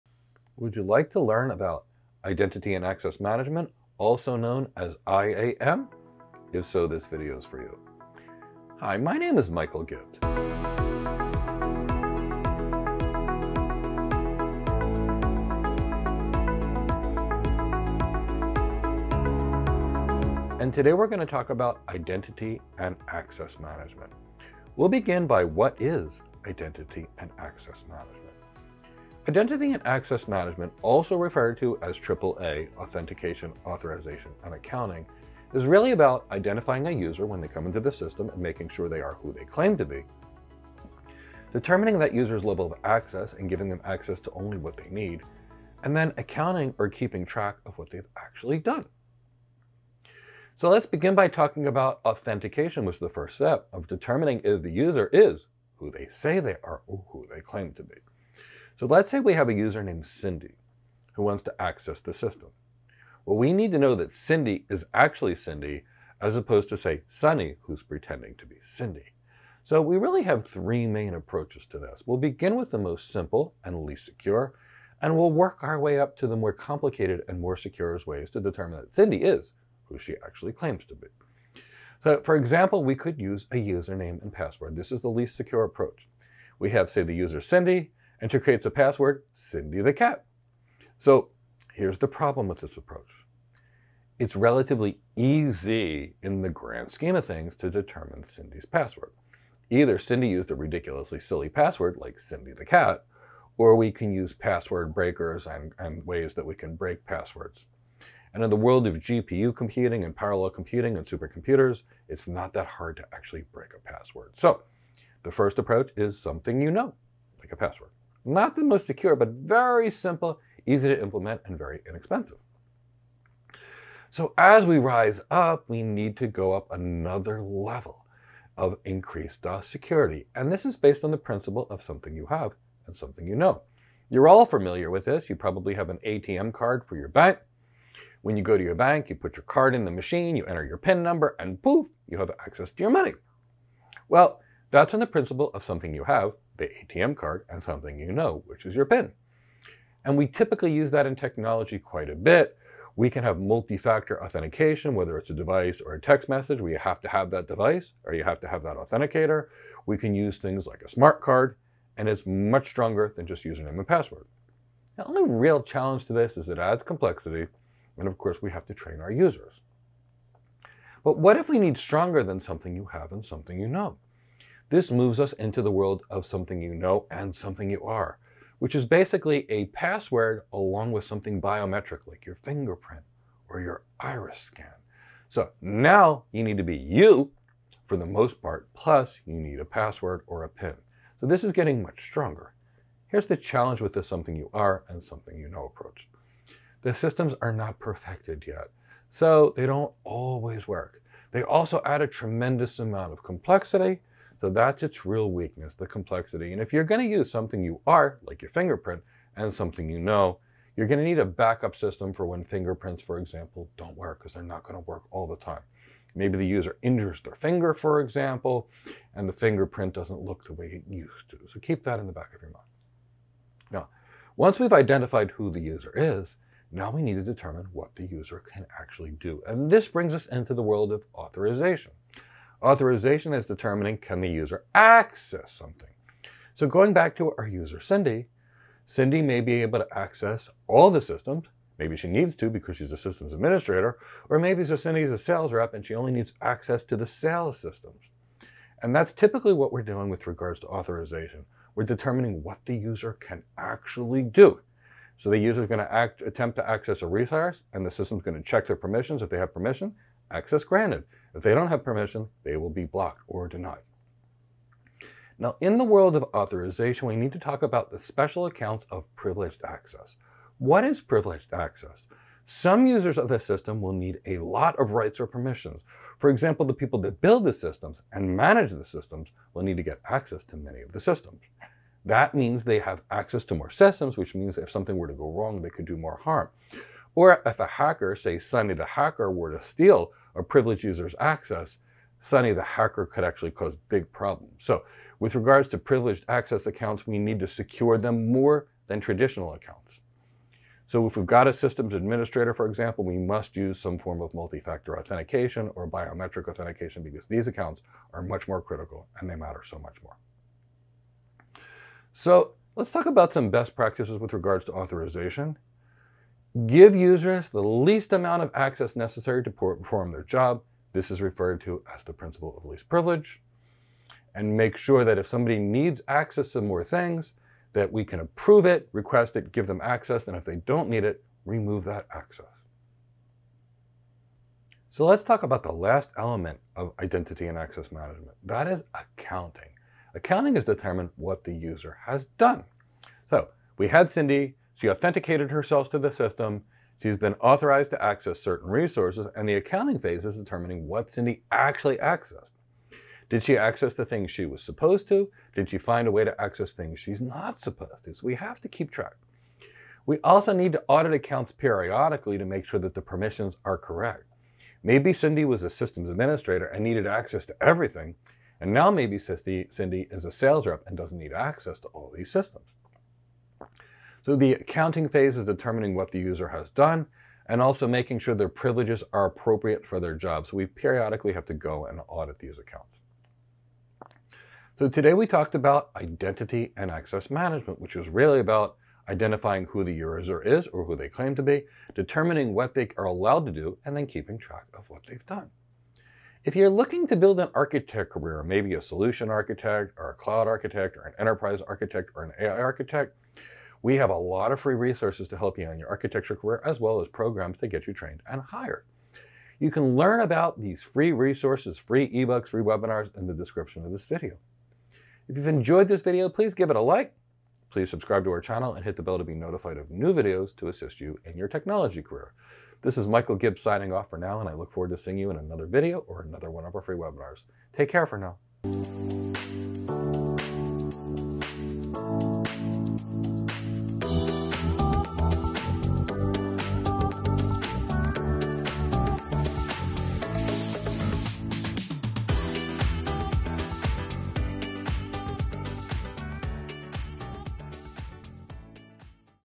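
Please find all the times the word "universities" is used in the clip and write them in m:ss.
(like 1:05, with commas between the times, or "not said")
not said.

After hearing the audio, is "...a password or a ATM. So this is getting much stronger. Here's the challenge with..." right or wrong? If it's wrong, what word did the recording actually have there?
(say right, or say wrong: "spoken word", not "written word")
wrong: "PIN", not "ATM".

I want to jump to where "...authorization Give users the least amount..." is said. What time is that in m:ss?
5:14.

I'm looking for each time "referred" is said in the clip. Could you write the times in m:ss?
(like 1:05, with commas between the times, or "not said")
0:31, 5:21.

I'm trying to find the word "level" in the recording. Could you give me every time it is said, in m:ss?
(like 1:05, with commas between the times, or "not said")
0:42, 2:07.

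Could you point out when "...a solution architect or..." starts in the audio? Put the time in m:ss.
6:38.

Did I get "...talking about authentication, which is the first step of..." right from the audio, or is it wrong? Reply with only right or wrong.
right.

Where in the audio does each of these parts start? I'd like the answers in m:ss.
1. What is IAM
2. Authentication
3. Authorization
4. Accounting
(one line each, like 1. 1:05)
1. 0:20
2. 0:52
3. 3:52
4. 5:35.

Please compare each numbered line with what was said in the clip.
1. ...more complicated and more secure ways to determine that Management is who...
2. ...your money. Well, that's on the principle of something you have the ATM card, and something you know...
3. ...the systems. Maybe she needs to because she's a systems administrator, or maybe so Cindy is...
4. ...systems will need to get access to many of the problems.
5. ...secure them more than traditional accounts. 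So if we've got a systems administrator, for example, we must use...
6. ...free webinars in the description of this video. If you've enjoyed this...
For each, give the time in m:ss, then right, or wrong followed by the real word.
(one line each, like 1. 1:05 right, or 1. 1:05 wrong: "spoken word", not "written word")
1. 1:16 wrong: "Cindy", not "Management"
2. 2:22 right
3. 4:00 right
4. 4:38 wrong: "systems", not "problems"
5. 4:57 right
6. 6:52 right.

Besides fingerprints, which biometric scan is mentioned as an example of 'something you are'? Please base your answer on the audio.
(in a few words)
iris scan.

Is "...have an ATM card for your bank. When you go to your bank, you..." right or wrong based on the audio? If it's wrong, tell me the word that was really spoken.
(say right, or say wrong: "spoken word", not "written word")
right.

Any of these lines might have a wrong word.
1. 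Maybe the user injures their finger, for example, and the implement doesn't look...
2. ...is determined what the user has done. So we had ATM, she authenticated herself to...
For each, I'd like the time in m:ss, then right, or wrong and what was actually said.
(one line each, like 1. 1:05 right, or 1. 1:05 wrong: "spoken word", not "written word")
1. 3:36 wrong: "fingerprint", not "implement"
2. 5:40 wrong: "Cindy", not "ATM".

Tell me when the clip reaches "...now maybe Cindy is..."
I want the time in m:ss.
6:08.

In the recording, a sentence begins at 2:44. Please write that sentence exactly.
The only real challenge to this is it adds complexity, and of course we have to train our users.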